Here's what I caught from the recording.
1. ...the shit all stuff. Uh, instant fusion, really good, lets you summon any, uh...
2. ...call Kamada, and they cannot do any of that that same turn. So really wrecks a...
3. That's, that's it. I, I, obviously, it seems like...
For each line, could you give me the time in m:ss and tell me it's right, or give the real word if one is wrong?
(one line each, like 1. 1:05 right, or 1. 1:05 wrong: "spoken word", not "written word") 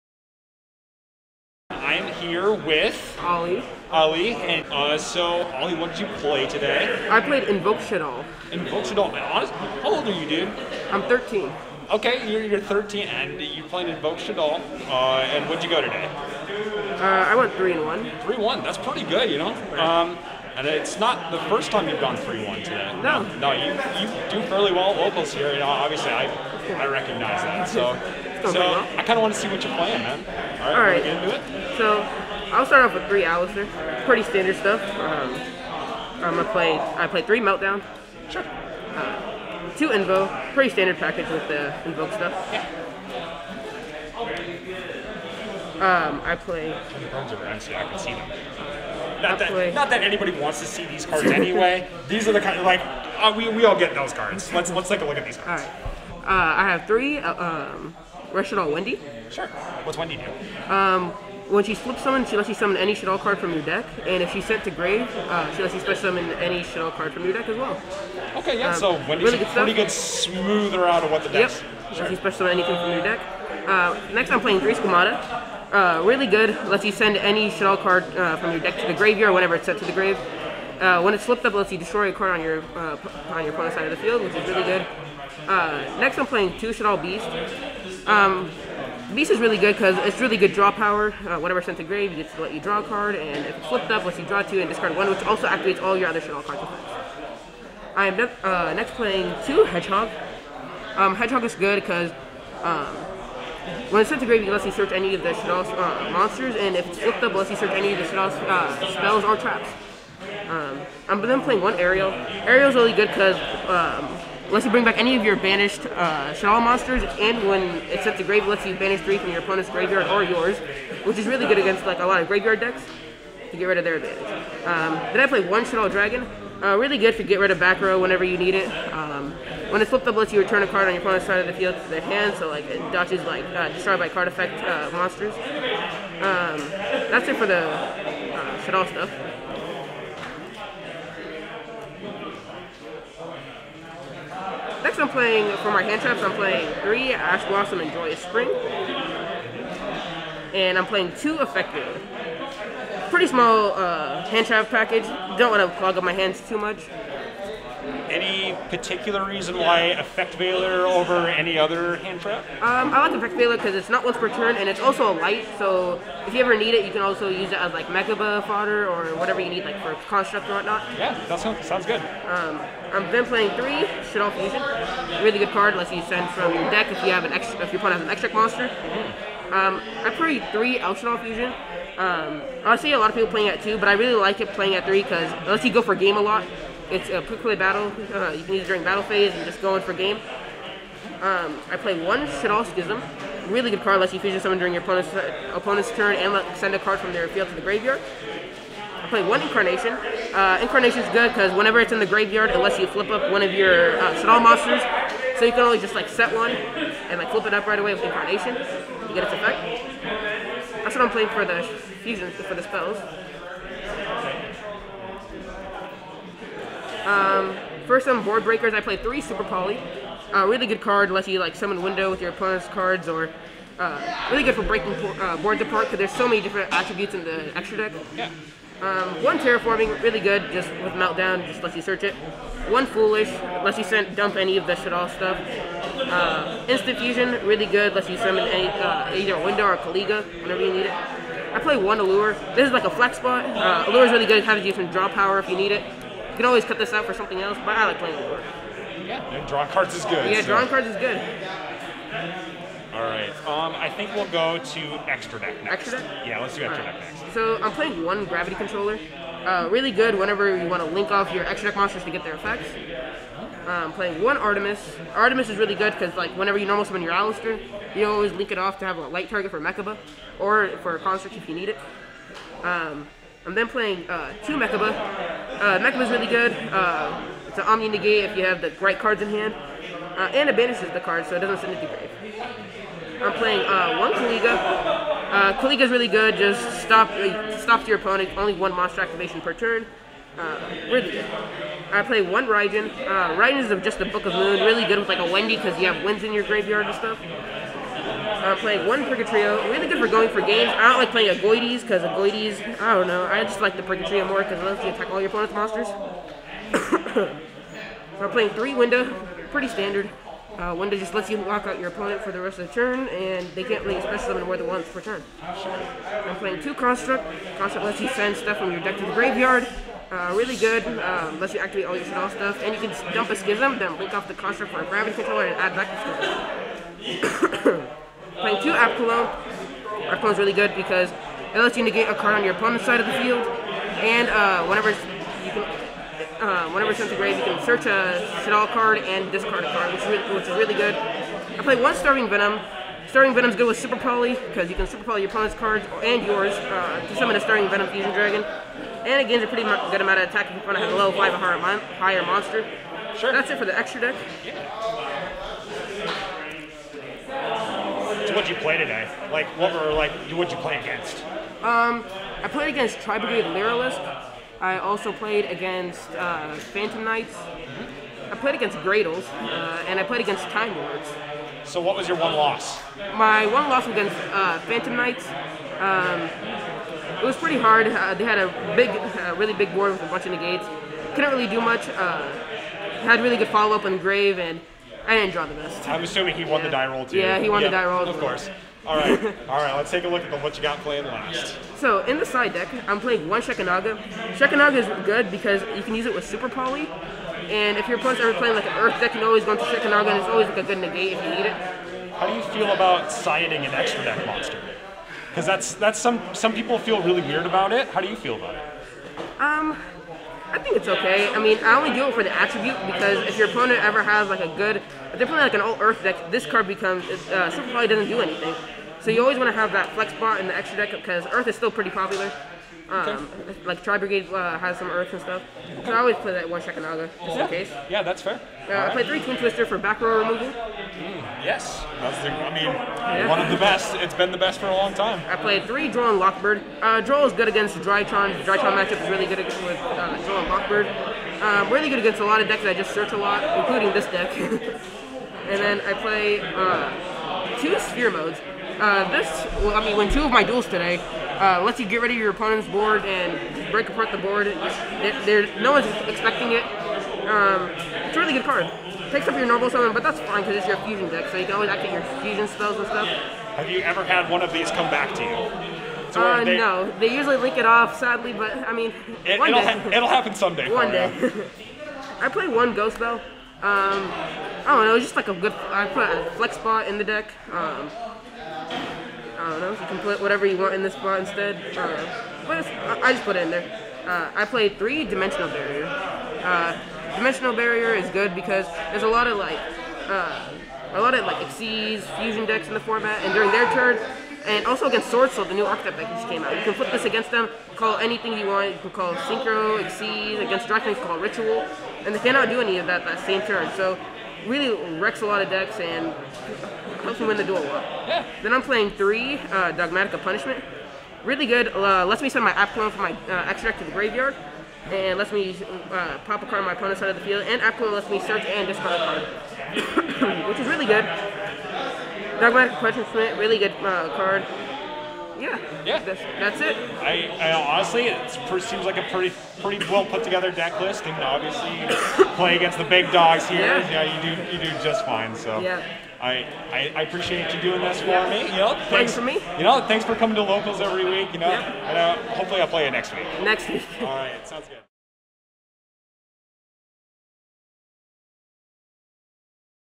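1. 3:54 right
2. 8:21 wrong: "Ritual", not "Kamada"
3. 8:46 wrong: "honestly", not "obviously".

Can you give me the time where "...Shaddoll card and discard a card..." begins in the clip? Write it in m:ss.
5:38.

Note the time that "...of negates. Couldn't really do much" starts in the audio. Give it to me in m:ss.
6:20.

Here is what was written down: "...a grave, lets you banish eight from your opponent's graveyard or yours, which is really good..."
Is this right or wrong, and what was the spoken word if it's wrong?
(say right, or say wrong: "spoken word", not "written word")
wrong: "three", not "eight".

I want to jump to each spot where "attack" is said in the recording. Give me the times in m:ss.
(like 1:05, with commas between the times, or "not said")
5:04, 5:50.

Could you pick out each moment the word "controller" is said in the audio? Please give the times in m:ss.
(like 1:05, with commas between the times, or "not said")
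4:18, 5:25.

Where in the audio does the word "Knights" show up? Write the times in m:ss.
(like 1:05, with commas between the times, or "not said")
6:07, 6:14.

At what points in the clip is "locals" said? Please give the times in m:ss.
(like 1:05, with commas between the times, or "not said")
0:24, 9:00.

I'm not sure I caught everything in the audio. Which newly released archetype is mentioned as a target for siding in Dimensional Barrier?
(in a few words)
Sword Soul.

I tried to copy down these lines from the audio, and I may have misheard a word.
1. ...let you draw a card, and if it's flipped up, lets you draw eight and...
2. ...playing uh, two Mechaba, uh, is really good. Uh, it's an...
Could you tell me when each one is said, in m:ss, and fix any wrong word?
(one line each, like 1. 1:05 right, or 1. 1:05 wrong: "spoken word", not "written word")
1. 1:32 wrong: "two", not "eight"
2. 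4:33 right.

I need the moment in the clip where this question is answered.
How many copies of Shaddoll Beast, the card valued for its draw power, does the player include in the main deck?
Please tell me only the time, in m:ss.
1:26.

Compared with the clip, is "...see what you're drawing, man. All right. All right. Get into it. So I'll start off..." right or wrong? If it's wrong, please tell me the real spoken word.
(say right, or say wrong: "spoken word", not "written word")
wrong: "playing", not "drawing".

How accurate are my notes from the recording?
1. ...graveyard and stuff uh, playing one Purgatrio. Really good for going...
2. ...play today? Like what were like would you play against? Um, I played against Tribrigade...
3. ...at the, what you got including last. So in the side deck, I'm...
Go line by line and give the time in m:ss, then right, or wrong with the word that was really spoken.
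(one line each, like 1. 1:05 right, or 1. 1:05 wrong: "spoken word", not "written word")
1. 4:56 right
2. 5:58 right
3. 6:30 wrong: "playing", not "including".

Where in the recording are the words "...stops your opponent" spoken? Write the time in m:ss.
4:47.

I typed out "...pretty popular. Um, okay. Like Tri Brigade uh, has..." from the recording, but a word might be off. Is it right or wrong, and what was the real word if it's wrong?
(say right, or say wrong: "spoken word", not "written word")
right.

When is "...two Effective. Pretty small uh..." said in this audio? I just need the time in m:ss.
2:31.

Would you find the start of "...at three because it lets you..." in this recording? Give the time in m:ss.
3:04.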